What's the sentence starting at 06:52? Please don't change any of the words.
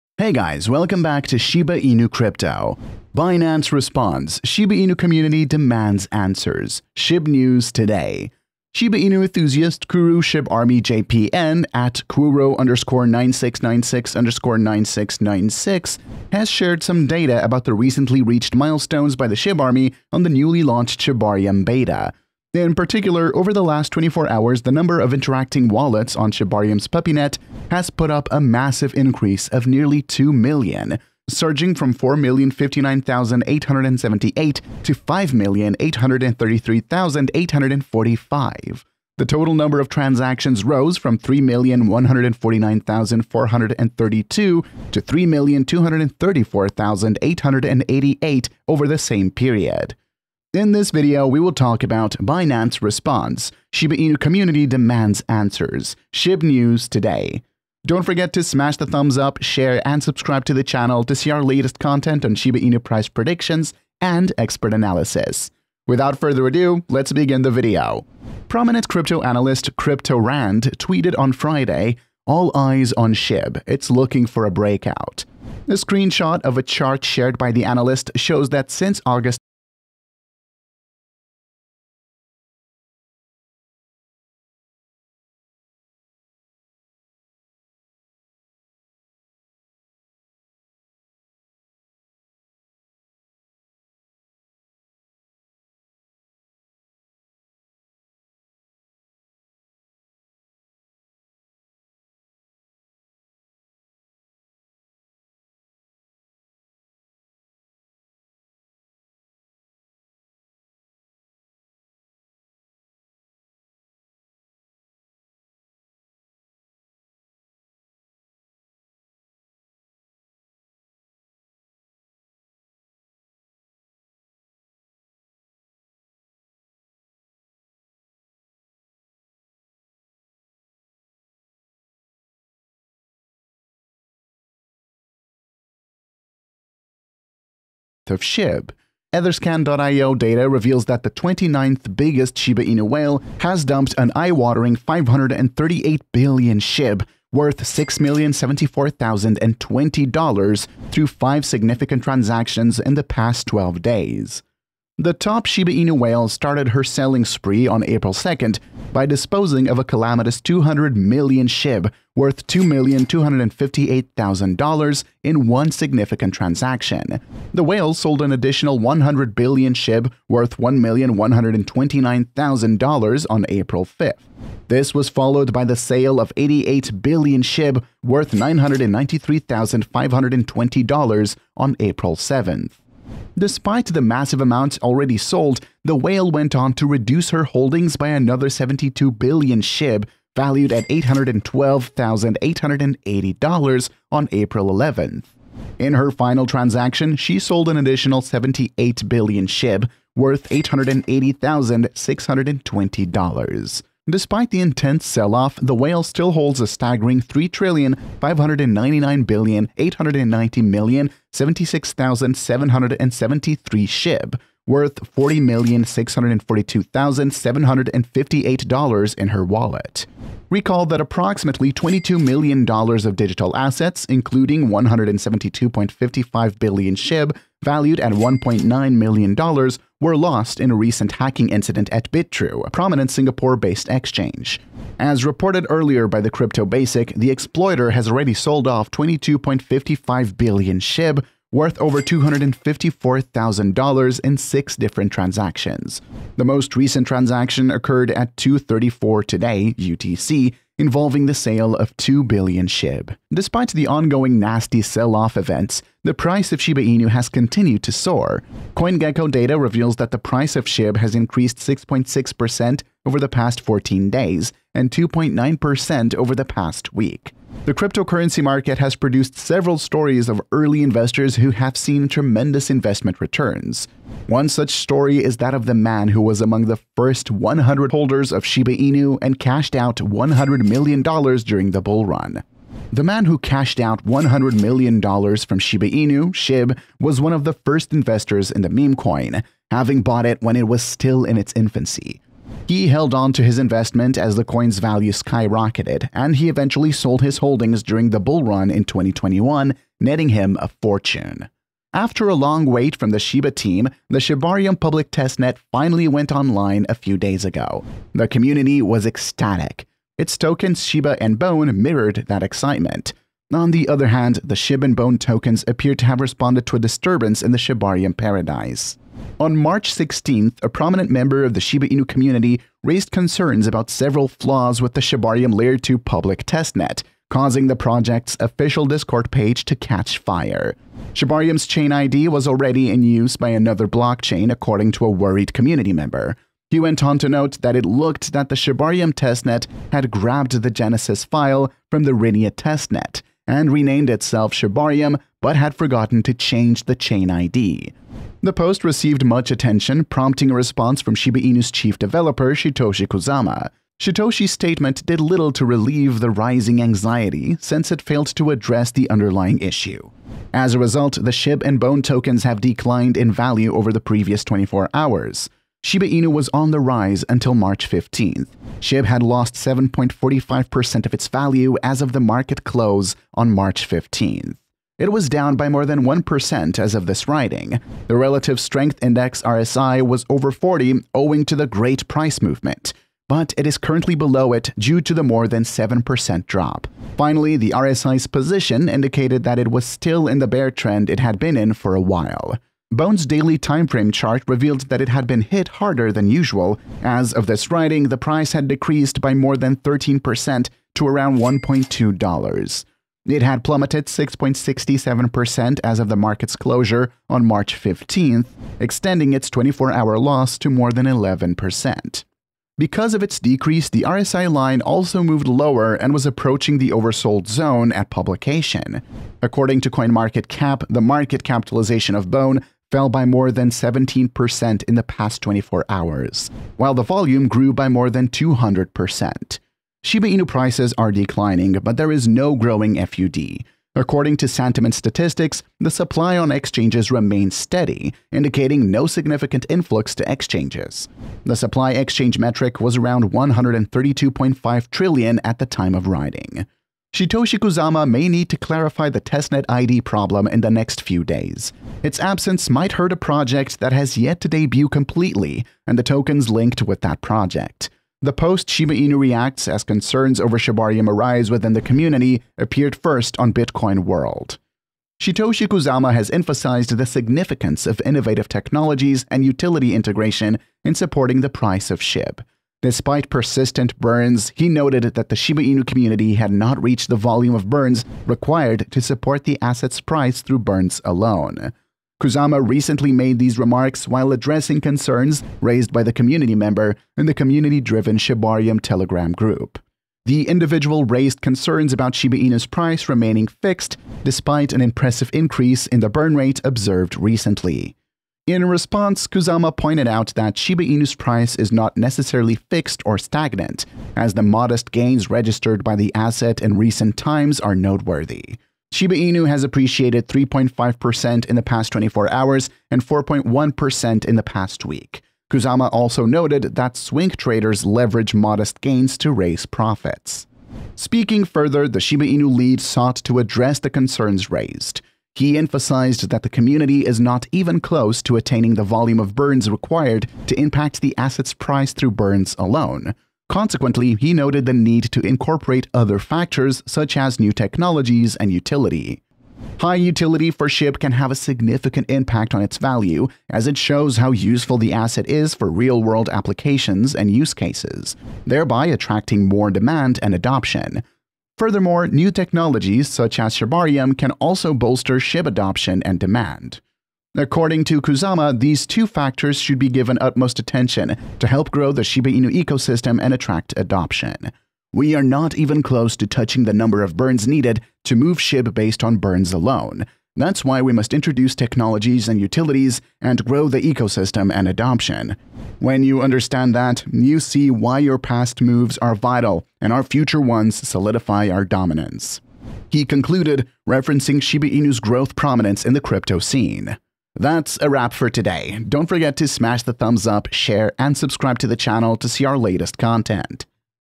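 Because of its decrease, the RSI line also moved lower and was approaching the oversold zone at publication.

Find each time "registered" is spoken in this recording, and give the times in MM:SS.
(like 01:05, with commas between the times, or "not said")
08:25.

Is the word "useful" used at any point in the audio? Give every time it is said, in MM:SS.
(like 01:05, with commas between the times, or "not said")
09:04.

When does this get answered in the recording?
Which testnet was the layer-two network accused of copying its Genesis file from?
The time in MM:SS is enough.
05:42.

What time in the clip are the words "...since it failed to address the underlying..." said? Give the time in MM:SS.
05:57.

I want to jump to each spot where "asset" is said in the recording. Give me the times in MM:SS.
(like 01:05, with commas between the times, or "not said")
07:59, 08:26, 08:51, 09:04.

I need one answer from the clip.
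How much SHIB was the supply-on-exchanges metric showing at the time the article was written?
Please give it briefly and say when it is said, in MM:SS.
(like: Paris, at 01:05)
132.5 trillion, at 07:23.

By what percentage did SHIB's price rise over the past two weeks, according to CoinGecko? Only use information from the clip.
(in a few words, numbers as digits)
6.6%.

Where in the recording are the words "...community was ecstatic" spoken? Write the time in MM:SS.
05:08.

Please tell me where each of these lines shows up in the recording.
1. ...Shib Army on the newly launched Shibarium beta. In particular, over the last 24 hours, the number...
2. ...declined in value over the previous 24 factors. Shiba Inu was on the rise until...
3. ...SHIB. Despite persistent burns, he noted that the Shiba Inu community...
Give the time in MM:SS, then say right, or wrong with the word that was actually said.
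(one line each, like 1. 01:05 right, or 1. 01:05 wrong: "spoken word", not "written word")
1. 00:19 right
2. 06:02 wrong: "hours", not "factors"
3. 07:51 right.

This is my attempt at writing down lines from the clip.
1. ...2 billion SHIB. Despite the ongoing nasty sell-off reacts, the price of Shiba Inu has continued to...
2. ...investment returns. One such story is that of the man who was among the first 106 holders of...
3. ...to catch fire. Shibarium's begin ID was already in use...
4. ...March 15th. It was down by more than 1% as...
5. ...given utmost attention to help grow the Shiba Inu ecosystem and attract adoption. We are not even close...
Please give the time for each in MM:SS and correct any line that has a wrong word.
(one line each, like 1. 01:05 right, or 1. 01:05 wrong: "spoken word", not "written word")
1. 04:11 wrong: "events", not "reacts"
2. 04:32 wrong: "100", not "106"
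3. 05:29 wrong: "chain", not "begin"
4. 06:13 right
5. 09:19 right.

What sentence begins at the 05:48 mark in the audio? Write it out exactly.
The post received much attention, prompting a response from Shiba Inu's chief developer, Shytoshi Kusama.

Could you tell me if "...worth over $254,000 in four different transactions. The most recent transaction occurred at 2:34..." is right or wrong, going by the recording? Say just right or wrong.
wrong.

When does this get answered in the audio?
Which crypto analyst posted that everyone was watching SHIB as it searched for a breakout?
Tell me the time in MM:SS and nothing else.
01:09.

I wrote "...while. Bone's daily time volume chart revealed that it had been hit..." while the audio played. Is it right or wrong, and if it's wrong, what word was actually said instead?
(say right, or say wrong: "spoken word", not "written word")
wrong: "frame", not "volume".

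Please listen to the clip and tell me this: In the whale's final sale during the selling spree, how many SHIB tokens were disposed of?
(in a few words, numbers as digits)
78 billion.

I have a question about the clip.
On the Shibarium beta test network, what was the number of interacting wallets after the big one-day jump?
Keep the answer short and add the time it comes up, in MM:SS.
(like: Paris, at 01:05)
5,833,845, at 00:34.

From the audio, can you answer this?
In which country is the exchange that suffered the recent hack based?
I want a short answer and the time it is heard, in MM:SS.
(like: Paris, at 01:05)
Singapore, at 03:53.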